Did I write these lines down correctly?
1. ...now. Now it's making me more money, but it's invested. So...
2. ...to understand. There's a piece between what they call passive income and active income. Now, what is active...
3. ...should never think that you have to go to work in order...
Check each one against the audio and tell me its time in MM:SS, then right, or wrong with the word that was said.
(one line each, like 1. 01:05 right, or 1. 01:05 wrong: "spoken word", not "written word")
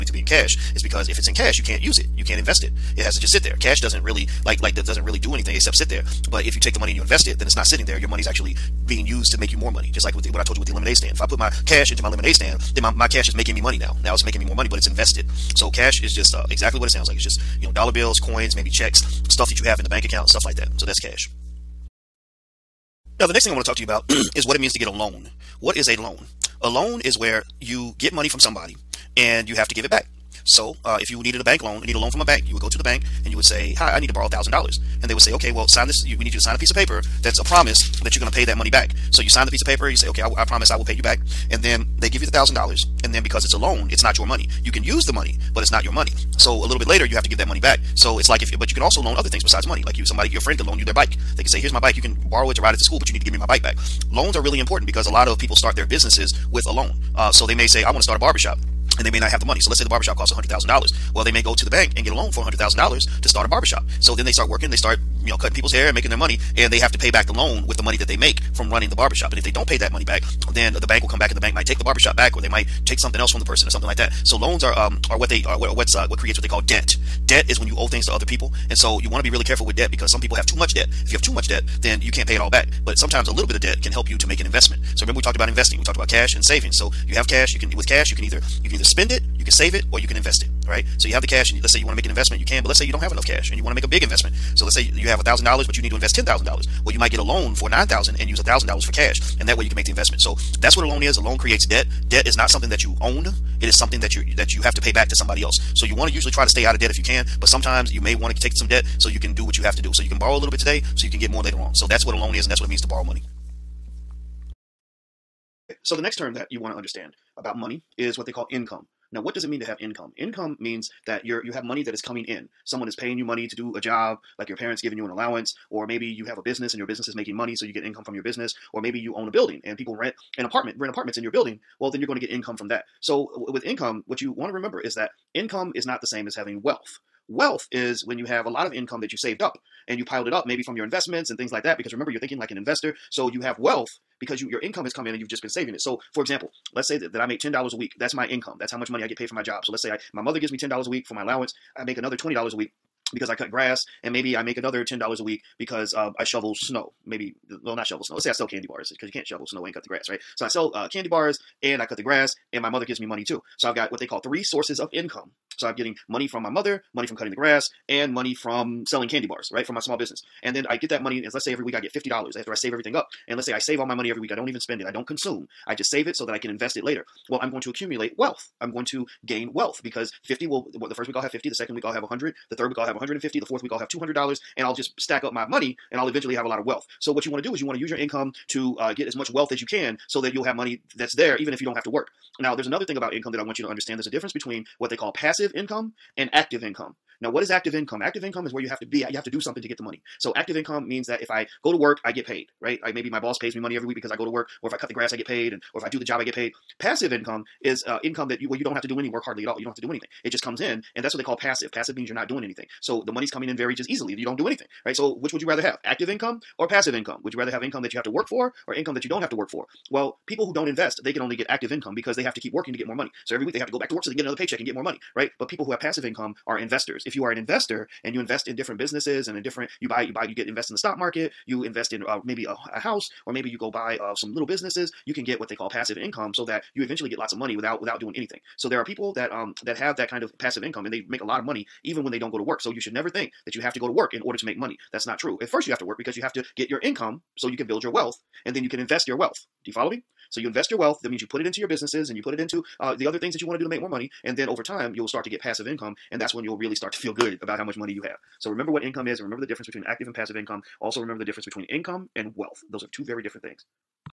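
1. 00:13 right
2. 03:13 wrong: "difference", not "piece"
3. 04:02 right.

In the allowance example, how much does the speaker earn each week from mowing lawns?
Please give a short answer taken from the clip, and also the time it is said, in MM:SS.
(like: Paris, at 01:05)
$20, at 02:32.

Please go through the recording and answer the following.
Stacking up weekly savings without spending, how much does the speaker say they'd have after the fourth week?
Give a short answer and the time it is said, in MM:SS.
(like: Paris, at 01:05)
$200, at 03:03.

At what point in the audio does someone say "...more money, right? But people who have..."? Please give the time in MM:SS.
03:44.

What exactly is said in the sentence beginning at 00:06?
But if you take the money and you invest it, then it's not sitting there.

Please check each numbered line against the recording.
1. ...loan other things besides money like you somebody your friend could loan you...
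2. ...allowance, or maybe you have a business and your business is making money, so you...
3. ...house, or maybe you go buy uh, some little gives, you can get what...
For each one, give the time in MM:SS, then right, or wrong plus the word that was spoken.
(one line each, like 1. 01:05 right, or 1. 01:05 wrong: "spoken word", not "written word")
1. 00:49 right
2. 02:05 right
3. 03:52 wrong: "businesses", not "gives".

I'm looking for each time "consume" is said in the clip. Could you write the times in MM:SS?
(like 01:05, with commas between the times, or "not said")
02:55.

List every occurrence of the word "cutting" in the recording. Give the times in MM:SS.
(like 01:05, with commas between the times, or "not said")
01:05, 02:47.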